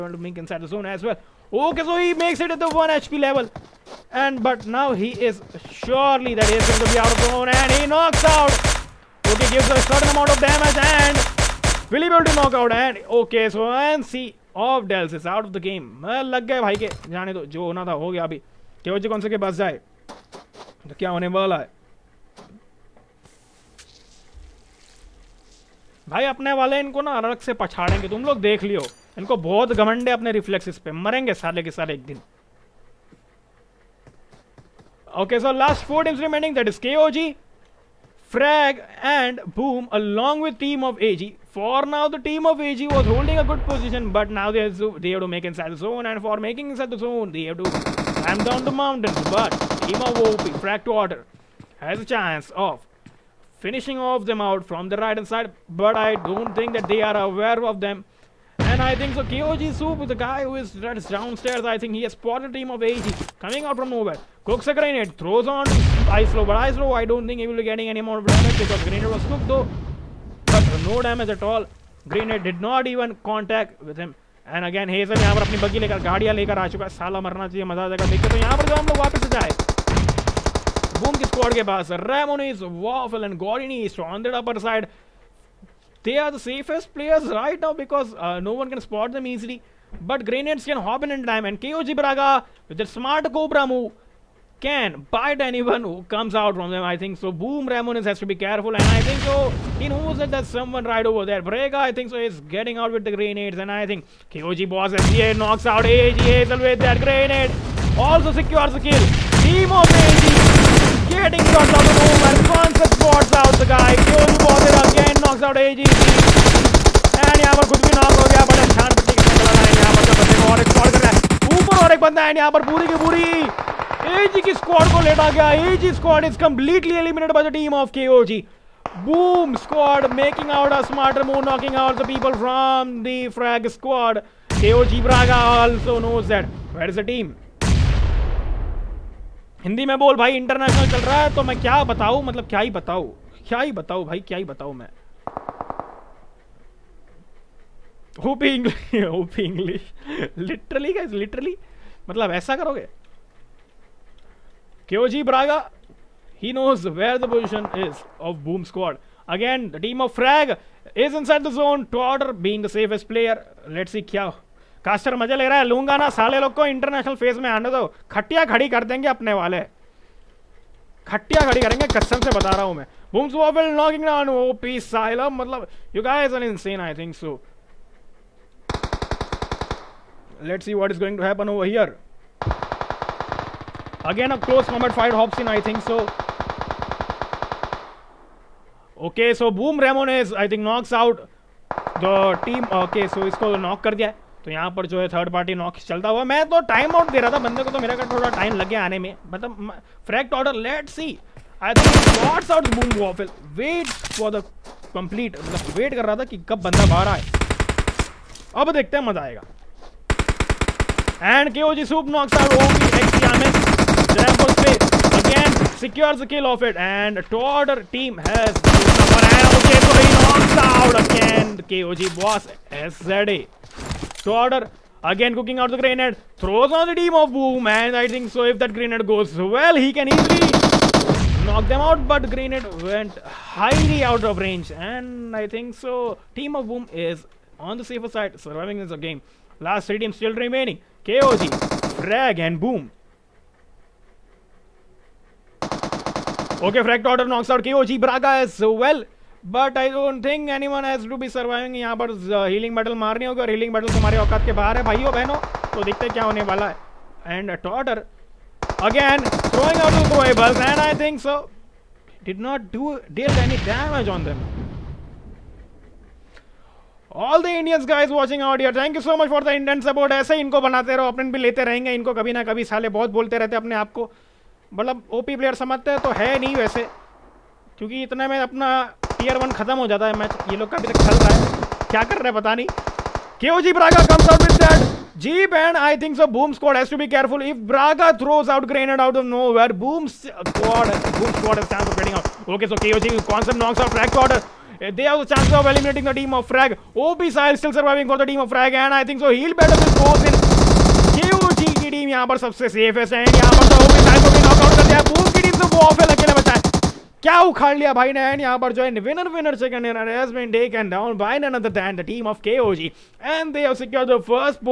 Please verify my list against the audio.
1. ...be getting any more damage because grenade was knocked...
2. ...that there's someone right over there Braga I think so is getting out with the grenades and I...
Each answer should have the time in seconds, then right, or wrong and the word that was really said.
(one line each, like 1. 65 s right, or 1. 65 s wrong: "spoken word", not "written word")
1. 67 s wrong: "cooked", not "knocked"
2. 100 s right.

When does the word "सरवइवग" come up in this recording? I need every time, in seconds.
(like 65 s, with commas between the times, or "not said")
251 s, 297 s.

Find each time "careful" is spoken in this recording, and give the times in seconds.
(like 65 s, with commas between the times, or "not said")
98 s.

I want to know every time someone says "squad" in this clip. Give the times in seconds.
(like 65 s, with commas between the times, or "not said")
129 s, 133 s.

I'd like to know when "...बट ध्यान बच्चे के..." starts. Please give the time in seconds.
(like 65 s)
118 s.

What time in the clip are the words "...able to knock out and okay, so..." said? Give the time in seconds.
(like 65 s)
12 s.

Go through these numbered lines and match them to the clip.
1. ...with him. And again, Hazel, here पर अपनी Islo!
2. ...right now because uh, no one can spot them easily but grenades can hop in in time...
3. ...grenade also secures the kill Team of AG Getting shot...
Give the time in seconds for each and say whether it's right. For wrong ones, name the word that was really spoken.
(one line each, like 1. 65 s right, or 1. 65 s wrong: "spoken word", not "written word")
1. 73 s wrong: "Boom", not "Islo"
2. 87 s right
3. 107 s right.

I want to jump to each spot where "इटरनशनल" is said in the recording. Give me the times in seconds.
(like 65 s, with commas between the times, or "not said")
140 s, 166 s.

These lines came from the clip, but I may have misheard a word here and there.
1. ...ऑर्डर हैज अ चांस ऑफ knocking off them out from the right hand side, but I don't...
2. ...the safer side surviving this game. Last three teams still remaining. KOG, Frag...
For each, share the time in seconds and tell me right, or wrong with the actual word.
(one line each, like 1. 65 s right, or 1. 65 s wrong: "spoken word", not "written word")
1. 51 s wrong: "finishing", not "knocking"
2. 237 s right.